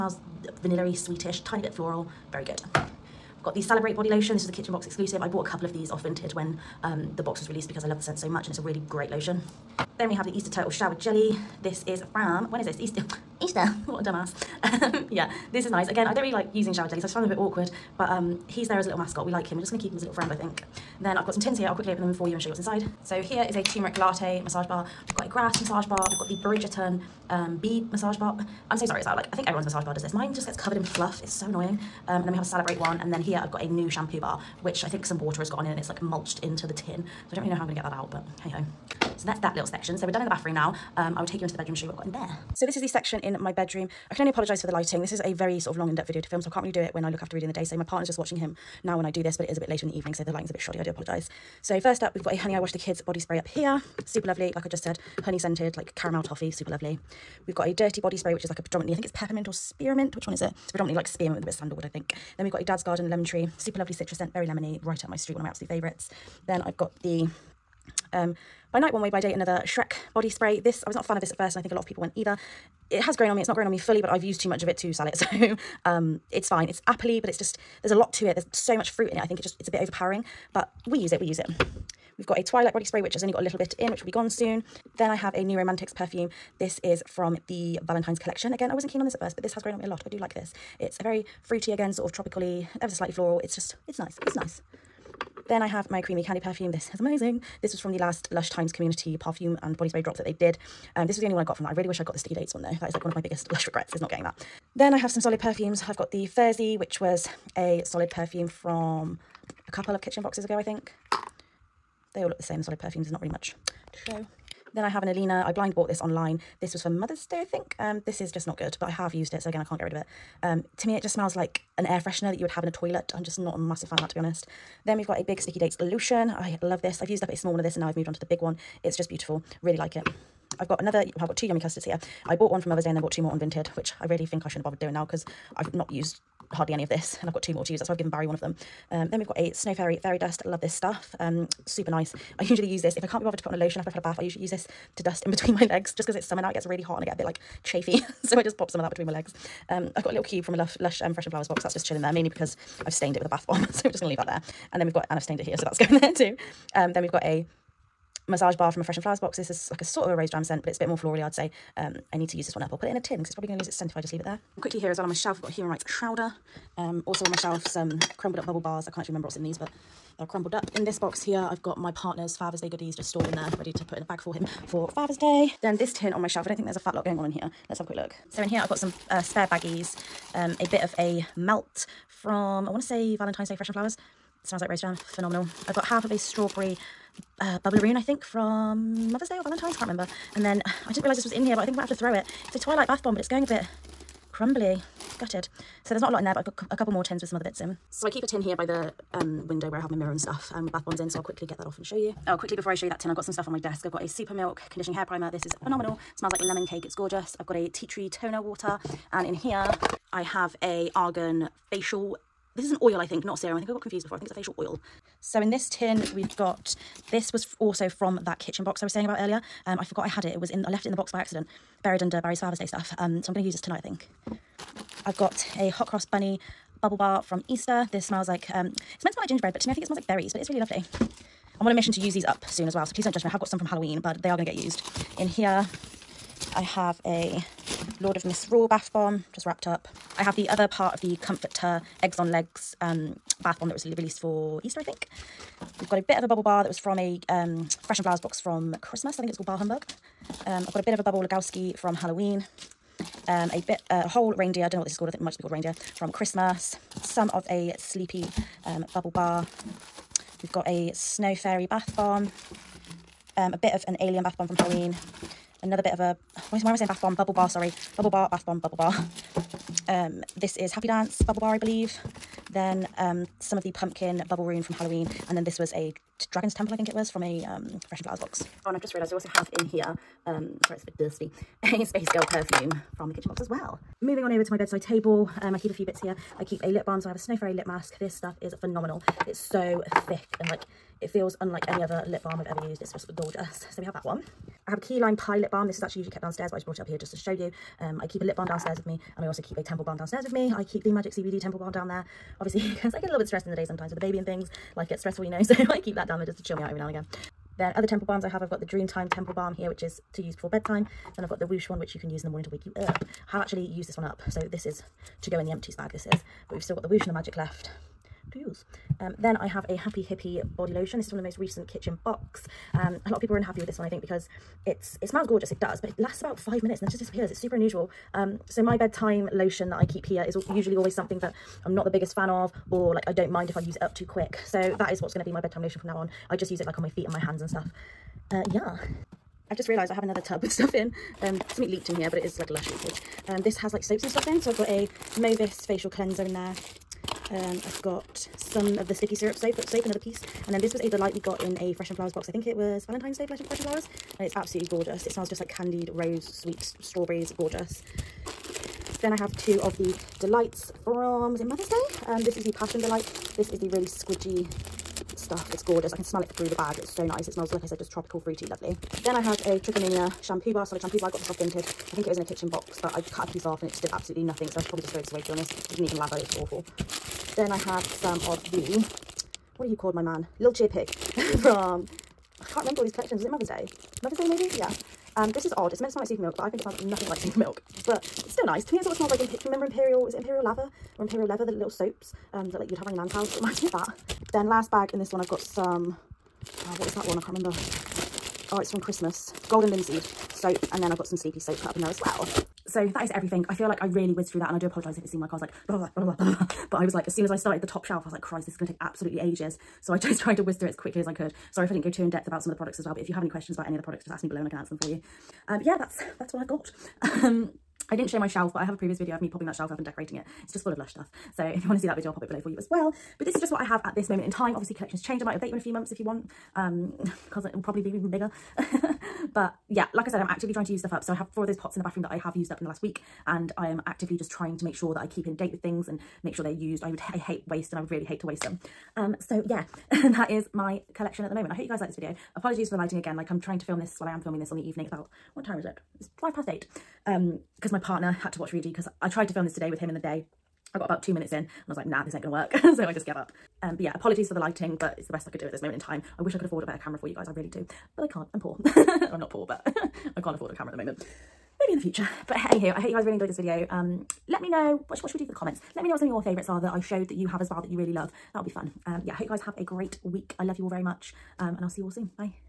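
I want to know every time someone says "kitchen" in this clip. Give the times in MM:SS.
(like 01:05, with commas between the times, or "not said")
00:04, 01:50, 03:38, 04:43, 05:21, 06:12.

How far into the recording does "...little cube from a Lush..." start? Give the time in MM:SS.
02:30.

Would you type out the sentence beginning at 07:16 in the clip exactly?
I would, I hate waste and I would really hate to waste them.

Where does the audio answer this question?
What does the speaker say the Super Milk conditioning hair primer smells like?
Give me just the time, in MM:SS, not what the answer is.
03:26.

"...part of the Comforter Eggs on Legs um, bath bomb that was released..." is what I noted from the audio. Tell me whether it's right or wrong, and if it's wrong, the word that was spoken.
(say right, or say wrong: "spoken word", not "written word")
right.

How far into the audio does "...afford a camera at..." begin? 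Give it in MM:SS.
07:40.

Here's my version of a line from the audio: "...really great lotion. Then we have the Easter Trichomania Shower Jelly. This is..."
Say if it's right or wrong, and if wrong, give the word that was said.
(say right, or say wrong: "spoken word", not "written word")
wrong: "Turtle", not "Trichomania".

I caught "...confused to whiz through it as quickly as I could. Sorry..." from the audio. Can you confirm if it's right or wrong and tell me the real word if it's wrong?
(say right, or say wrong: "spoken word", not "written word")
wrong: "tried", not "confused".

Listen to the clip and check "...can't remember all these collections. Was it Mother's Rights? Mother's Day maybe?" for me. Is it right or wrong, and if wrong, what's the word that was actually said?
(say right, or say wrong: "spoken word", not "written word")
wrong: "Day", not "Rights".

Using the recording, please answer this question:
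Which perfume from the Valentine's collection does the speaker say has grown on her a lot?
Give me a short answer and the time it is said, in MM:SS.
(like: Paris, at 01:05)
New Romantics, at 01:25.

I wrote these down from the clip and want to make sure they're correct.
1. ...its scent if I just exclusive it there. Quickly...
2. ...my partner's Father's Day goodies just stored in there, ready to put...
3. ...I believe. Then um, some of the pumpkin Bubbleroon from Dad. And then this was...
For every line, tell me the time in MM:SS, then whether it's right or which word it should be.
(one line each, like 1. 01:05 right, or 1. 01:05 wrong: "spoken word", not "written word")
1. 02:43 wrong: "leave", not "exclusive"
2. 02:51 right
3. 04:31 wrong: "Halloween", not "Dad".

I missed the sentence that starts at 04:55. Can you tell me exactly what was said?
This is actually usually kept downstairs, but I just brought it up here just to show you.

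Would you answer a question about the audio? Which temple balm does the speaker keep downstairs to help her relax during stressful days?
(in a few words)
Magic CBD temple balm.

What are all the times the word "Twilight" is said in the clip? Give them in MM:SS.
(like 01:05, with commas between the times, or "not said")
01:22, 03:12.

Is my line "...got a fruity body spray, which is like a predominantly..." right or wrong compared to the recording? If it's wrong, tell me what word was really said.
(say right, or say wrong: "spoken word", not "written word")
wrong: "dirty", not "fruity".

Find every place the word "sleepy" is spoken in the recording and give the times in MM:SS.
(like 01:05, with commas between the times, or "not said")
04:17, 06:41.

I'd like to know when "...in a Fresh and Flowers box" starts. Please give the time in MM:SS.
05:51.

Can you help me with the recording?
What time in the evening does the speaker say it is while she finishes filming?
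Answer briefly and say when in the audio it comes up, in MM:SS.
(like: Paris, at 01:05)
8:05, at 07:26.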